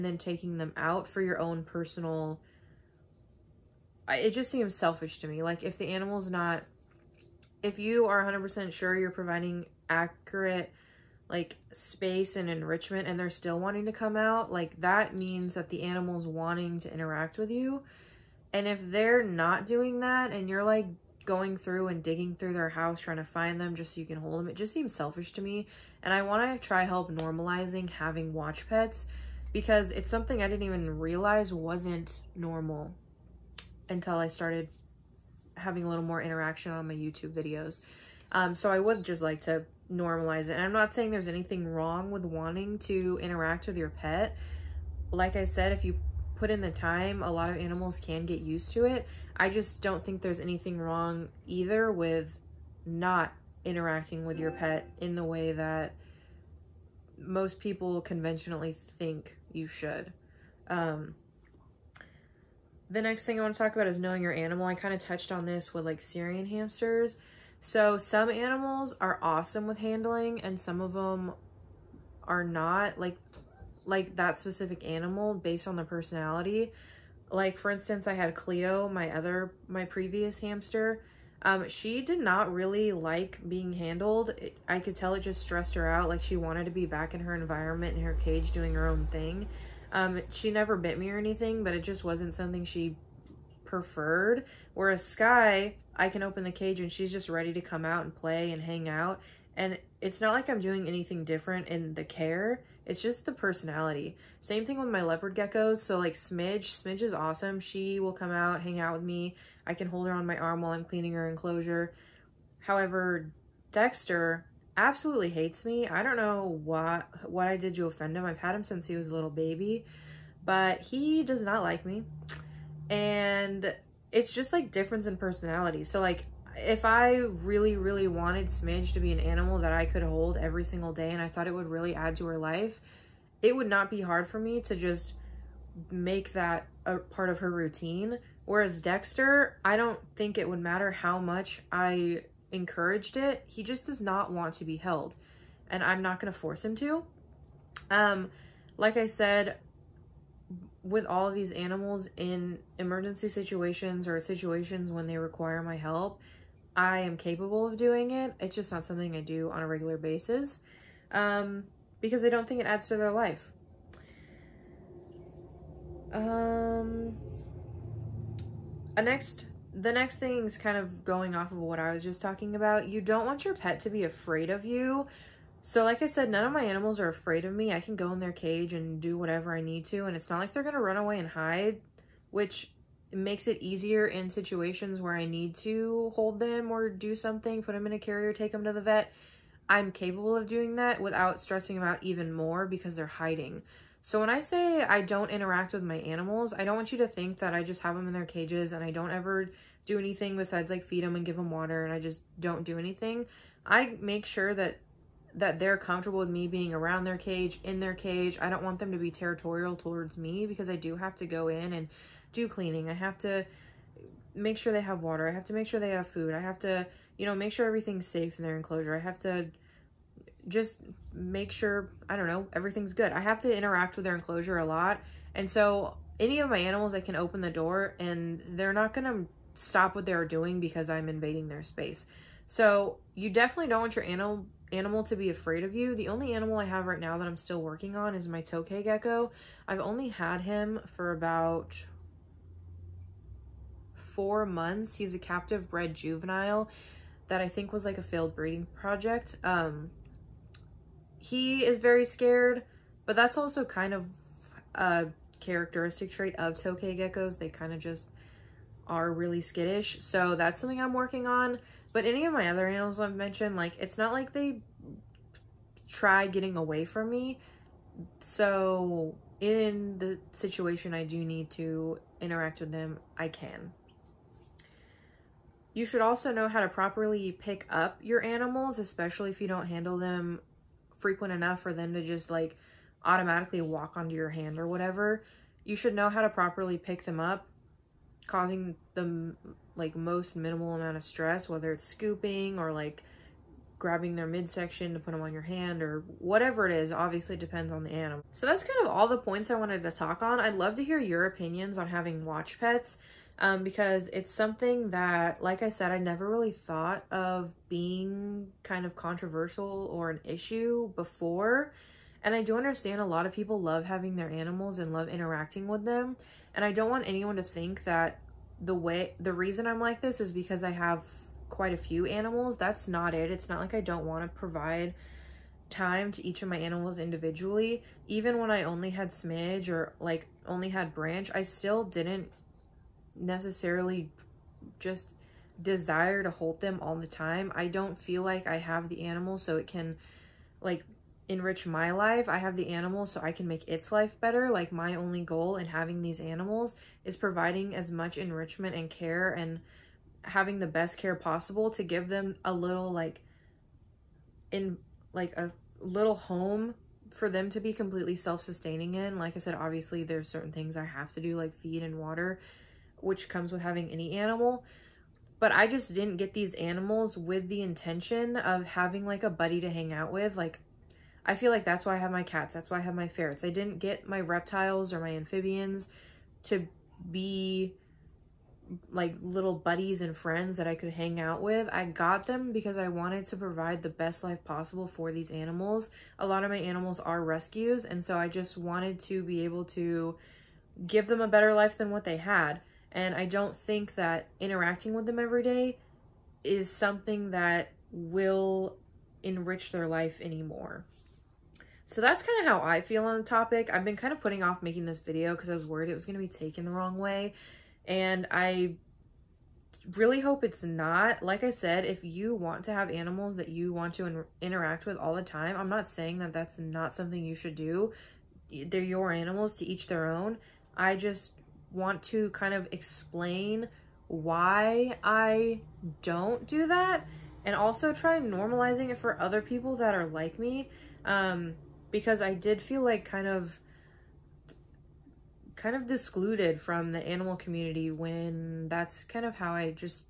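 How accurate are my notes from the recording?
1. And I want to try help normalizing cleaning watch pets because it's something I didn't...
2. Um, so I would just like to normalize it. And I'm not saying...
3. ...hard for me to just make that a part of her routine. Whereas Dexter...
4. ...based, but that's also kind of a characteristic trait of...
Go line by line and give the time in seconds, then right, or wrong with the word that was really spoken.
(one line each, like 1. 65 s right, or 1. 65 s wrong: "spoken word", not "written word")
1. 26 s wrong: "having", not "cleaning"
2. 38 s right
3. 134 s right
4. 252 s wrong: "scared", not "based".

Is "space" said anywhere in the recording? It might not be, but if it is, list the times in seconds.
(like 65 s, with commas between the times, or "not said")
11 s, 231 s.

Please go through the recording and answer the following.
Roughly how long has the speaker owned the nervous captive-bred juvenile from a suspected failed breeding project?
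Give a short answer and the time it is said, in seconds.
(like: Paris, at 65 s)
4 months, at 244 s.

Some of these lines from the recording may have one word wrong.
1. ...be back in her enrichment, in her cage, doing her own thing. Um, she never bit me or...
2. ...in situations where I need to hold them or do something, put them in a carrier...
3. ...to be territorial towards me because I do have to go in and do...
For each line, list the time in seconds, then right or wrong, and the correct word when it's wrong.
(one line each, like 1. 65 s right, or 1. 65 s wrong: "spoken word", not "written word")
1. 86 s wrong: "environment", not "enrichment"
2. 184 s right
3. 208 s right.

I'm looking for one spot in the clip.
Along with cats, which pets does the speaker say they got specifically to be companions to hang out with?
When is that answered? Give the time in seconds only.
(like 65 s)
373 s.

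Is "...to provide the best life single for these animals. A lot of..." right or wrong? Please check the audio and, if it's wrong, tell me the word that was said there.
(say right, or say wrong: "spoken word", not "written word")
wrong: "possible", not "single".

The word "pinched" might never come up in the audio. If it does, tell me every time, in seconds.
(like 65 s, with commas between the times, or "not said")
not said.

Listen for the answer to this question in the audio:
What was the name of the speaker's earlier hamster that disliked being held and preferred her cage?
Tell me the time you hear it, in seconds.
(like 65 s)
78 s.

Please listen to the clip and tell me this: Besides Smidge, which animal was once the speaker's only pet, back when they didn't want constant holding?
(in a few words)
Branch.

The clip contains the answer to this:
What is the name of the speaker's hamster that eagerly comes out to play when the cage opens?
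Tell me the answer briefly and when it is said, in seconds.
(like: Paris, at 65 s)
Sky, at 95 s.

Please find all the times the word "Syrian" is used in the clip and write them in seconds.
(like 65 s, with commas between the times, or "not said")
66 s.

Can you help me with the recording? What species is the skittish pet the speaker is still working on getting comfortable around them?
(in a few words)
Tokay gecko.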